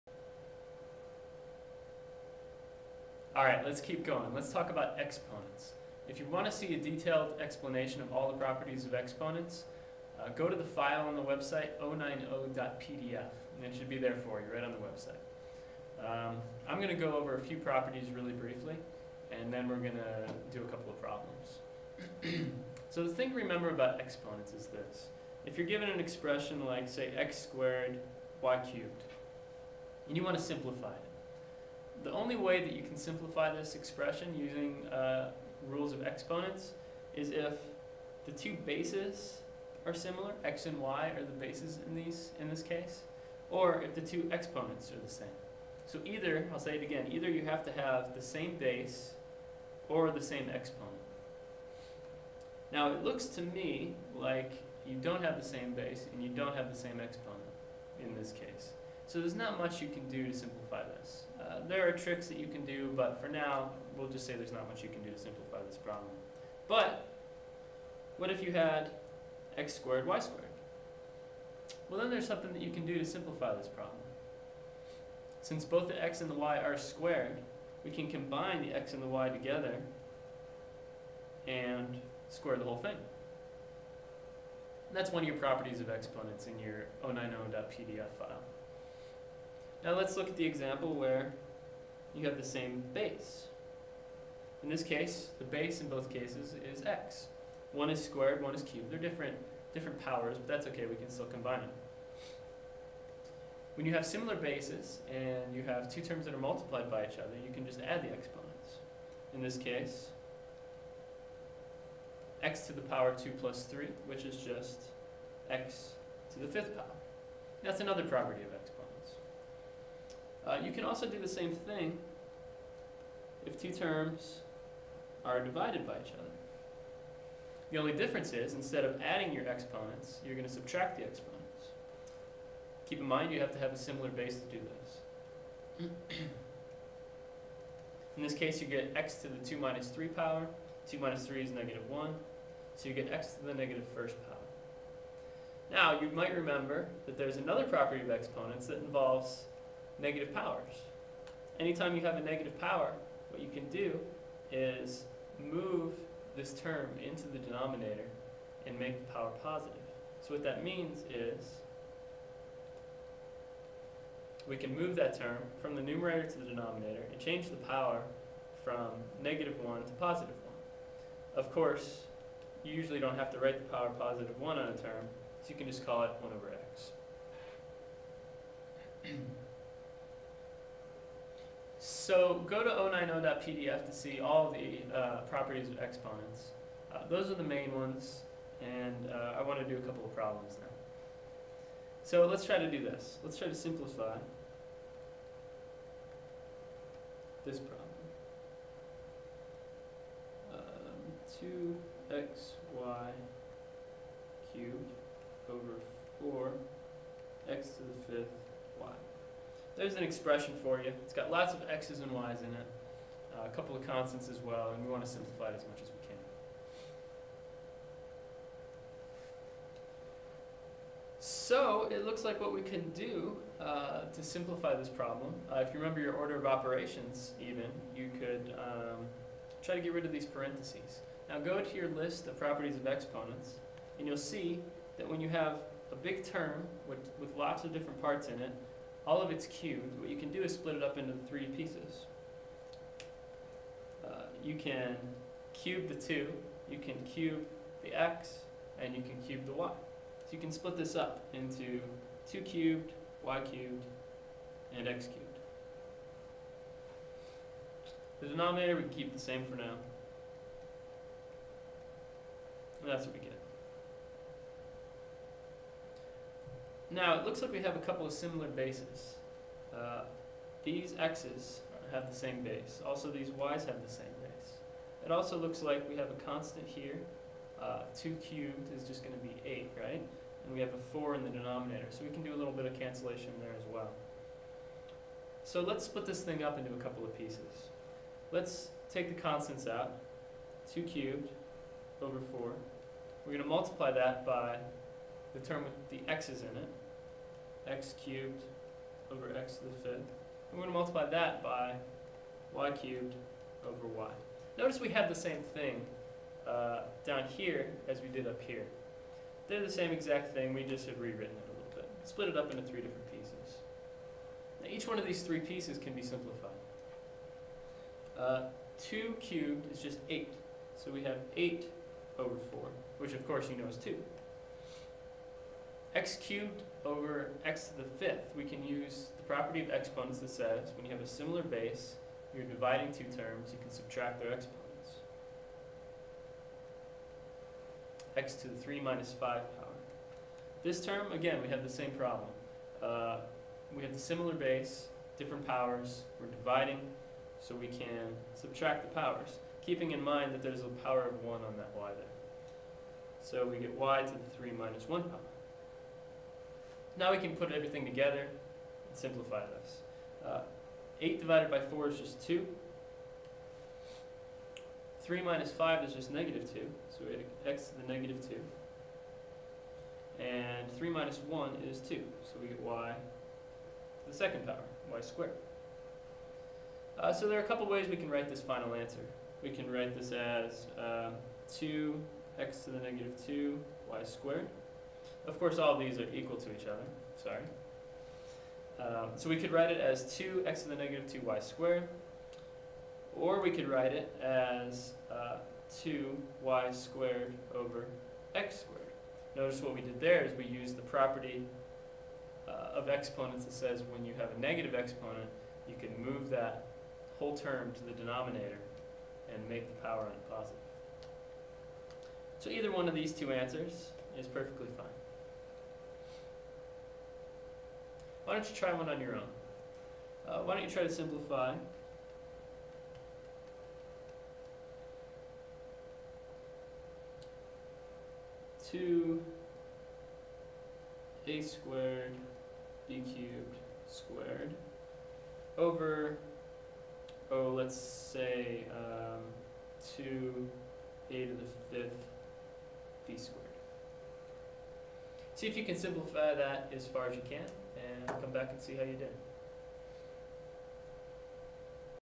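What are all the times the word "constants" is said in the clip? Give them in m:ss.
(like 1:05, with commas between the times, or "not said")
3:33, 4:36, 4:49.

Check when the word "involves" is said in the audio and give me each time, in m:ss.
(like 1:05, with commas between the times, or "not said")
2:28.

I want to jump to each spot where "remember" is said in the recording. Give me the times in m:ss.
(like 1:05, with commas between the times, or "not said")
0:23, 2:26, 3:45.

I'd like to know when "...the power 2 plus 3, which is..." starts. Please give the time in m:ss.
1:52.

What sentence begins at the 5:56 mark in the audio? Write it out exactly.
Now we can put everything together and simplify this.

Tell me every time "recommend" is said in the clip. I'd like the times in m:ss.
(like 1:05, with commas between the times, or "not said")
not said.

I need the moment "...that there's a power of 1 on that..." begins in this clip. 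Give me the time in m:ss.
5:50.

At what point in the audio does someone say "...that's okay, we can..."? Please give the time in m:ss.
1:40.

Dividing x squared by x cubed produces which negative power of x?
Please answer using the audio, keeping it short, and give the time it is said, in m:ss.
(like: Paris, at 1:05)
negative first power, at 2:23.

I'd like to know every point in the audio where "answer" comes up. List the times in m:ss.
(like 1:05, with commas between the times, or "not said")
6:18, 6:53.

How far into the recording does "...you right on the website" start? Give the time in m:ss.
0:14.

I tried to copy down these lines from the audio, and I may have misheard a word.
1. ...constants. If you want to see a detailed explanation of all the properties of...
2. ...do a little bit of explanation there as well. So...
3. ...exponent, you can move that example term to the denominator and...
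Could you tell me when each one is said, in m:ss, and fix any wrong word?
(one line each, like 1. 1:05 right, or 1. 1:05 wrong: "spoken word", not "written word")
1. 0:04 wrong: "exponents", not "constants"
2. 4:42 wrong: "cancellation", not "explanation"
3. 6:44 wrong: "whole", not "example".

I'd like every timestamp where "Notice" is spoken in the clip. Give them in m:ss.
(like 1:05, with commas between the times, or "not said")
5:04, 6:39.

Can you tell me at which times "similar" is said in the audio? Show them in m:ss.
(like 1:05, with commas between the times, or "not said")
0:39, 1:44, 2:13, 4:28, 5:31, 5:43.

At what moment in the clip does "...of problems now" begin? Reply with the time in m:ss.
3:10.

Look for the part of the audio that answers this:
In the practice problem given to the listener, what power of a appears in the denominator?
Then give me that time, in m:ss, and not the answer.
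7:21.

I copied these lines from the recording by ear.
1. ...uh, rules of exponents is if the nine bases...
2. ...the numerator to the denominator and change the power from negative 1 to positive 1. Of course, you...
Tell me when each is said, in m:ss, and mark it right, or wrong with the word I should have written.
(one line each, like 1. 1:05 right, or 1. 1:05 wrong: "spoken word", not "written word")
1. 0:34 wrong: "two", not "nine"
2. 2:45 right.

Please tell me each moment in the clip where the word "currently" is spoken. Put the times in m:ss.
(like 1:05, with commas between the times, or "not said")
not said.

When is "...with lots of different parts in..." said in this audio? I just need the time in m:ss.
3:57.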